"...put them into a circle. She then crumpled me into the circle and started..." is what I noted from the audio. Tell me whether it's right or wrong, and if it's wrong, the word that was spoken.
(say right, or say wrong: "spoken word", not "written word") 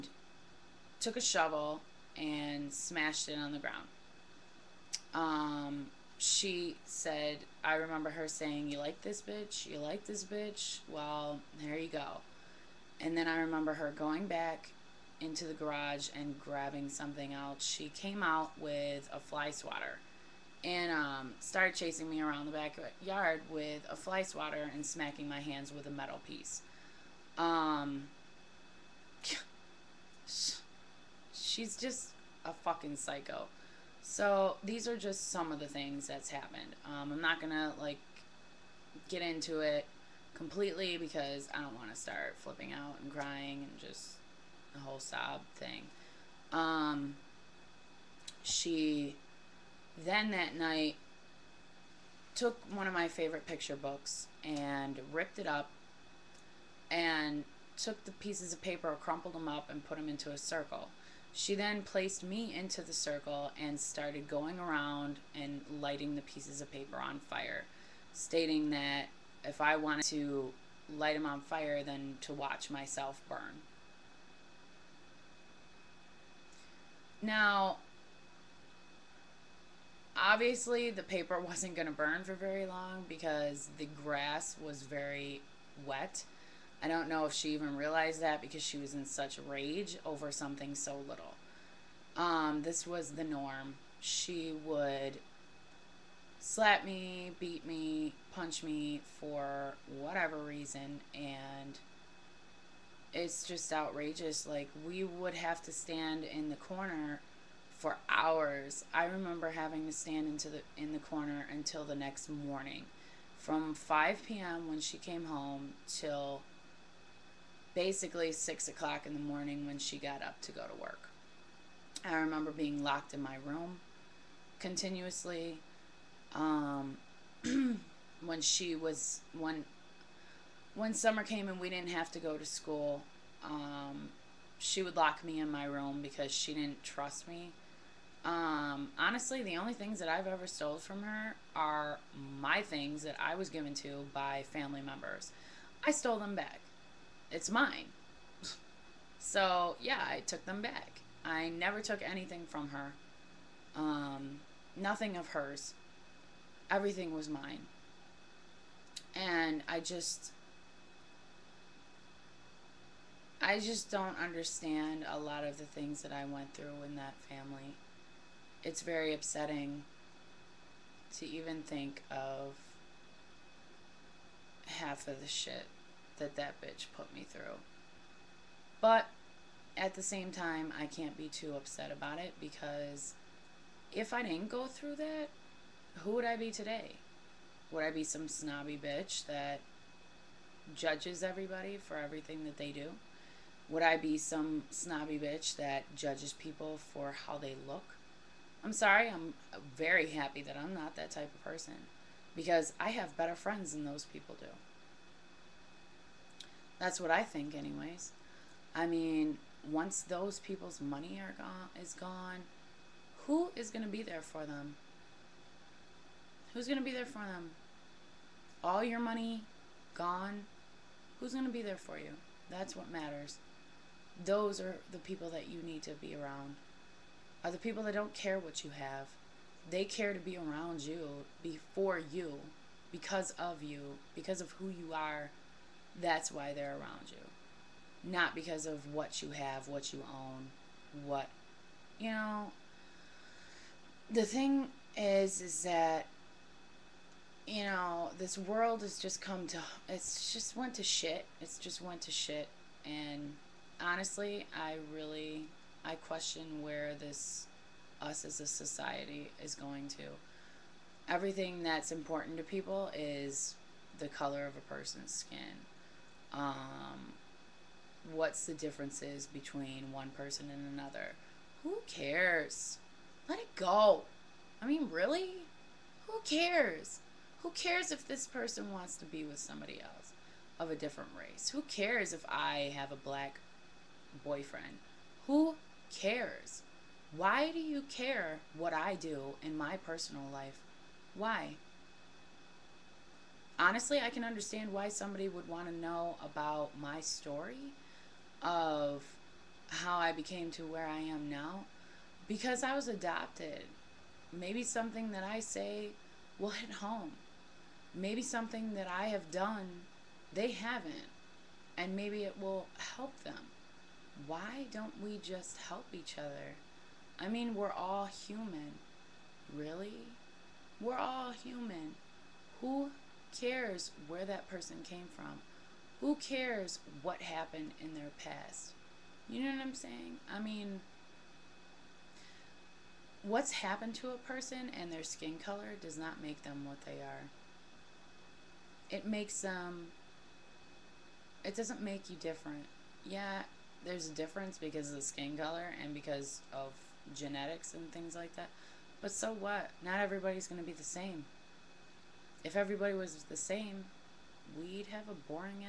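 wrong: "placed", not "crumpled".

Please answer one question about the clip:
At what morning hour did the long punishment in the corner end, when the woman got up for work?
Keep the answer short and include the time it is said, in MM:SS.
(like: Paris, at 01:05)
6, at 01:58.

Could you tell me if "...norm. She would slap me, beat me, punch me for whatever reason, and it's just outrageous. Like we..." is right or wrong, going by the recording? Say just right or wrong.
right.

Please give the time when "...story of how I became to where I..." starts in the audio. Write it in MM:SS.
04:57.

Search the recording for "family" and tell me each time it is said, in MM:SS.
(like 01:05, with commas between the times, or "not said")
02:24, 02:47.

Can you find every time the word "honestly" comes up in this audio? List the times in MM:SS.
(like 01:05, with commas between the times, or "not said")
02:18, 04:13, 04:53.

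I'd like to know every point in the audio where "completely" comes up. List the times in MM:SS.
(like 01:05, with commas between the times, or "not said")
00:40.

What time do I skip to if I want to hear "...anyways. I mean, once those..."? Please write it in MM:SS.
03:27.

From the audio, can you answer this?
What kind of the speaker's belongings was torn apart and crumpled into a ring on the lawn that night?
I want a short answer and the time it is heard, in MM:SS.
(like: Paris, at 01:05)
picture books, at 00:53.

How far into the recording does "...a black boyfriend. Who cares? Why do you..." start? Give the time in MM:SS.
04:42.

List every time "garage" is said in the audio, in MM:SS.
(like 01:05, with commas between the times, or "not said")
00:15.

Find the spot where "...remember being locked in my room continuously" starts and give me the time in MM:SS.
02:02.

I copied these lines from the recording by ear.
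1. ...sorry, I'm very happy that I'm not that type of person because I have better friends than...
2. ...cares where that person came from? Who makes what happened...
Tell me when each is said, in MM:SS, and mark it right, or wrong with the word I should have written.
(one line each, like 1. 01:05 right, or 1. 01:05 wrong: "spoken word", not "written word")
1. 03:18 right
2. 05:23 wrong: "cares", not "makes".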